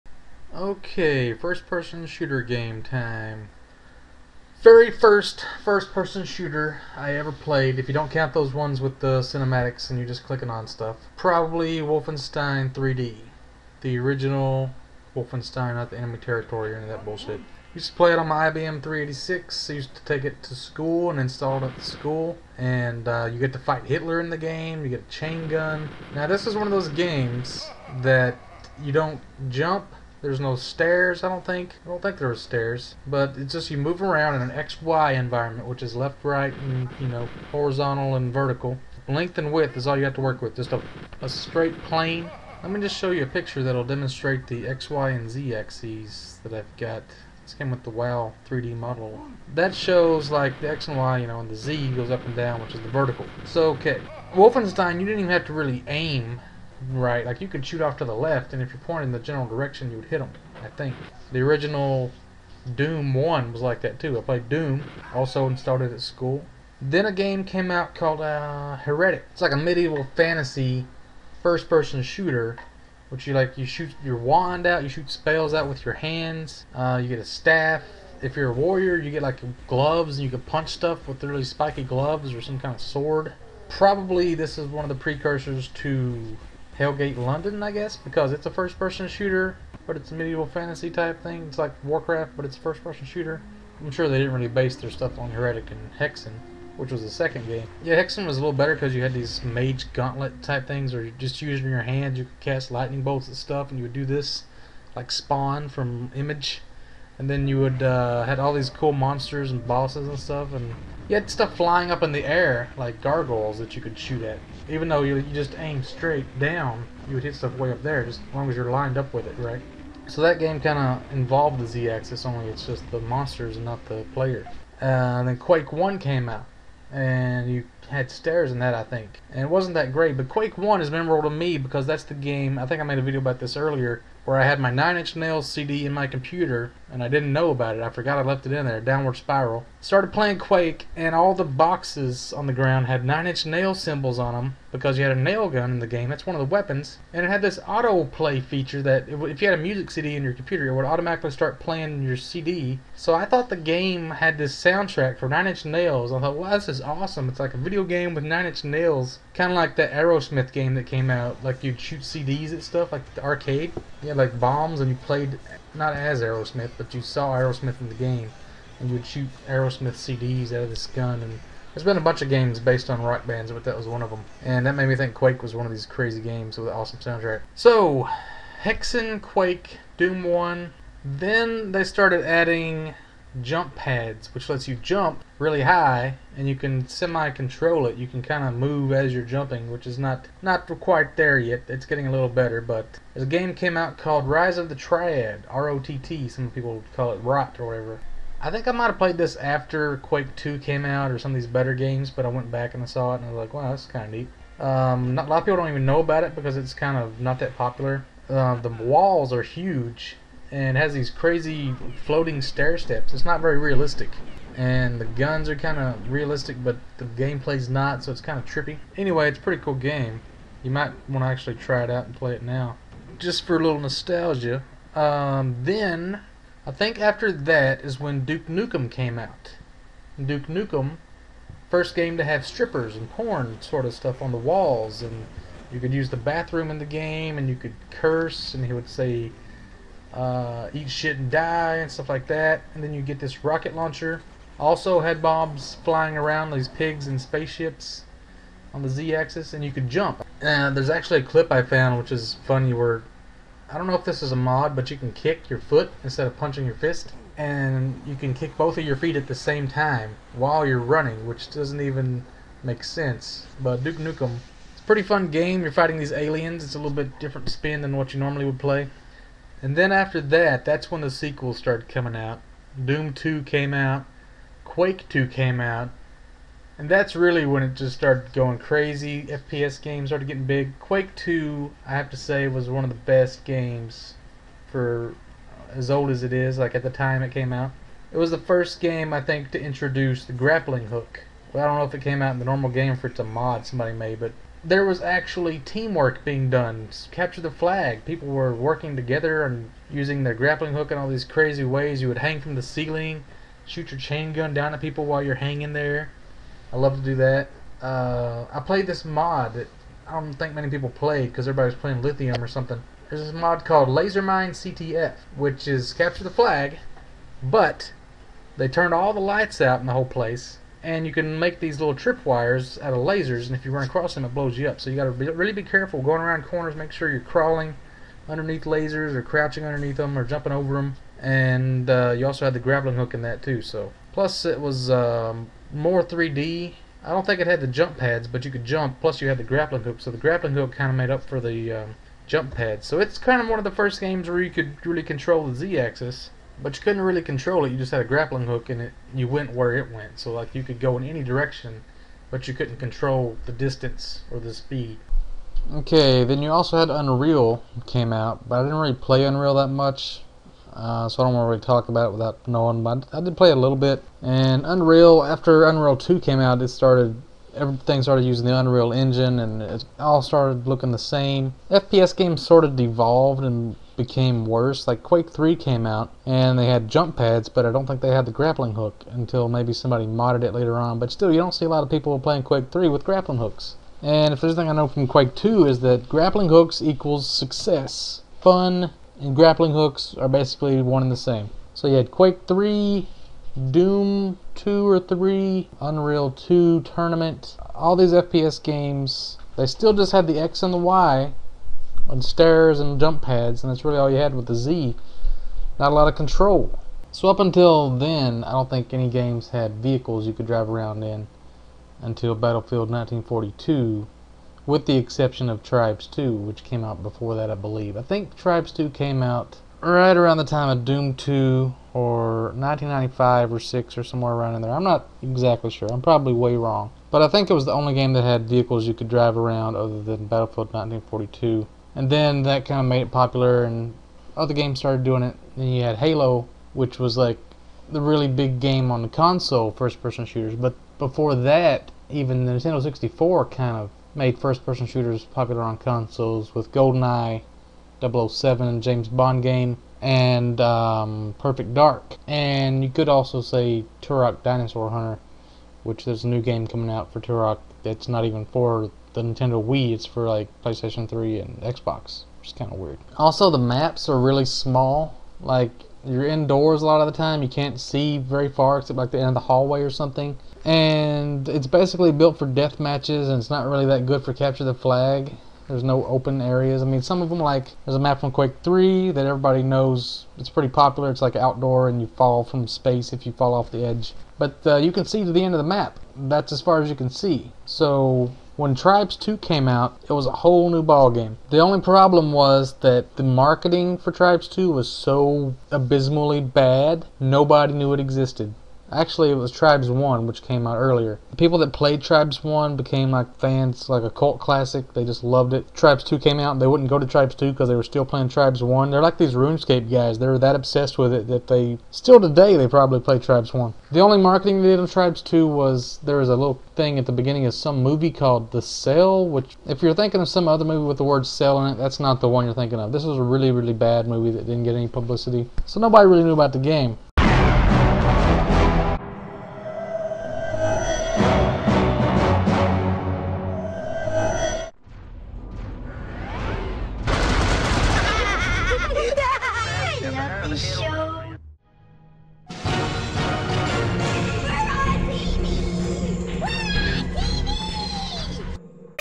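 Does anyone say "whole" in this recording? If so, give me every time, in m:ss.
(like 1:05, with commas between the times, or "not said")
5:19, 8:10.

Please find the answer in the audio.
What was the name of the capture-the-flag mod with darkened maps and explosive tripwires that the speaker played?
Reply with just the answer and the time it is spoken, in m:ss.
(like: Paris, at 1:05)
Lasermine CTF, at 5:13.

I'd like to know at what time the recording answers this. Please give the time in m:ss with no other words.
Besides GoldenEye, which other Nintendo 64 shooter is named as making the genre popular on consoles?
7:31.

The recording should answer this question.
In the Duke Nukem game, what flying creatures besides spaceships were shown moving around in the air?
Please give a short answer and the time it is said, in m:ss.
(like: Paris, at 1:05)
pigs, at 4:06.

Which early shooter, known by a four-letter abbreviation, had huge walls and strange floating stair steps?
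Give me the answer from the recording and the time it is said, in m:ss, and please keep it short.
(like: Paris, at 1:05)
Rise of the Triad, at 3:14.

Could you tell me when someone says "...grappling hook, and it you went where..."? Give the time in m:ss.
5:48.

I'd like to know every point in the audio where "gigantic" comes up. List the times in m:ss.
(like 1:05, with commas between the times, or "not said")
not said.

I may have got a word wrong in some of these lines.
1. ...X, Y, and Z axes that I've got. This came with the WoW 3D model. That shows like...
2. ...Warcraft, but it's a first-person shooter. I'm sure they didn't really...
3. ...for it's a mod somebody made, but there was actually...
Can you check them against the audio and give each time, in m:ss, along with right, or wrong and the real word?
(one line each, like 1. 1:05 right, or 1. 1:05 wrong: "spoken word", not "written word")
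1. 0:44 right
2. 1:31 right
3. 4:52 right.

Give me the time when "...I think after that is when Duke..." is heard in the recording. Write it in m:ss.
3:46.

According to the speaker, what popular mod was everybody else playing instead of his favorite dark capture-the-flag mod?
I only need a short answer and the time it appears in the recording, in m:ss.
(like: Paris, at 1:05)
Lithium, at 5:12.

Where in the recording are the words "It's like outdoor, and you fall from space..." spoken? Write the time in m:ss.
8:01.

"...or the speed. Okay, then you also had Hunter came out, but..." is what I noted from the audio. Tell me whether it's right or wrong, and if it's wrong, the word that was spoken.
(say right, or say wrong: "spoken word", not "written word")
wrong: "Unreal", not "Hunter".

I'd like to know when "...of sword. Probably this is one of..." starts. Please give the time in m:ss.
1:22.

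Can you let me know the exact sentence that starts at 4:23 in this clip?
But Duke Nukem, it's a pretty fun game.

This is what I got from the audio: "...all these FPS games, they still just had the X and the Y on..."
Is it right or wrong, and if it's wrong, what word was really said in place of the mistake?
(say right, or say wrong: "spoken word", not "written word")
right.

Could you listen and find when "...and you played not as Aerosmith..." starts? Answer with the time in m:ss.
2:44.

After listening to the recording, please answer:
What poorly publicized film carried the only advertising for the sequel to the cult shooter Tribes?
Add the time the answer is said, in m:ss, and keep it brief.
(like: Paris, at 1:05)
The Cell, at 8:38.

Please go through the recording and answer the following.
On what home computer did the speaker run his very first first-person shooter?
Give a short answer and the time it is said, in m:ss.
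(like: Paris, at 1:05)
IBM 386, at 0:18.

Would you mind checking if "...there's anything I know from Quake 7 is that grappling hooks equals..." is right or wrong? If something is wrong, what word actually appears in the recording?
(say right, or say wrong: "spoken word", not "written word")
wrong: "2", not "7".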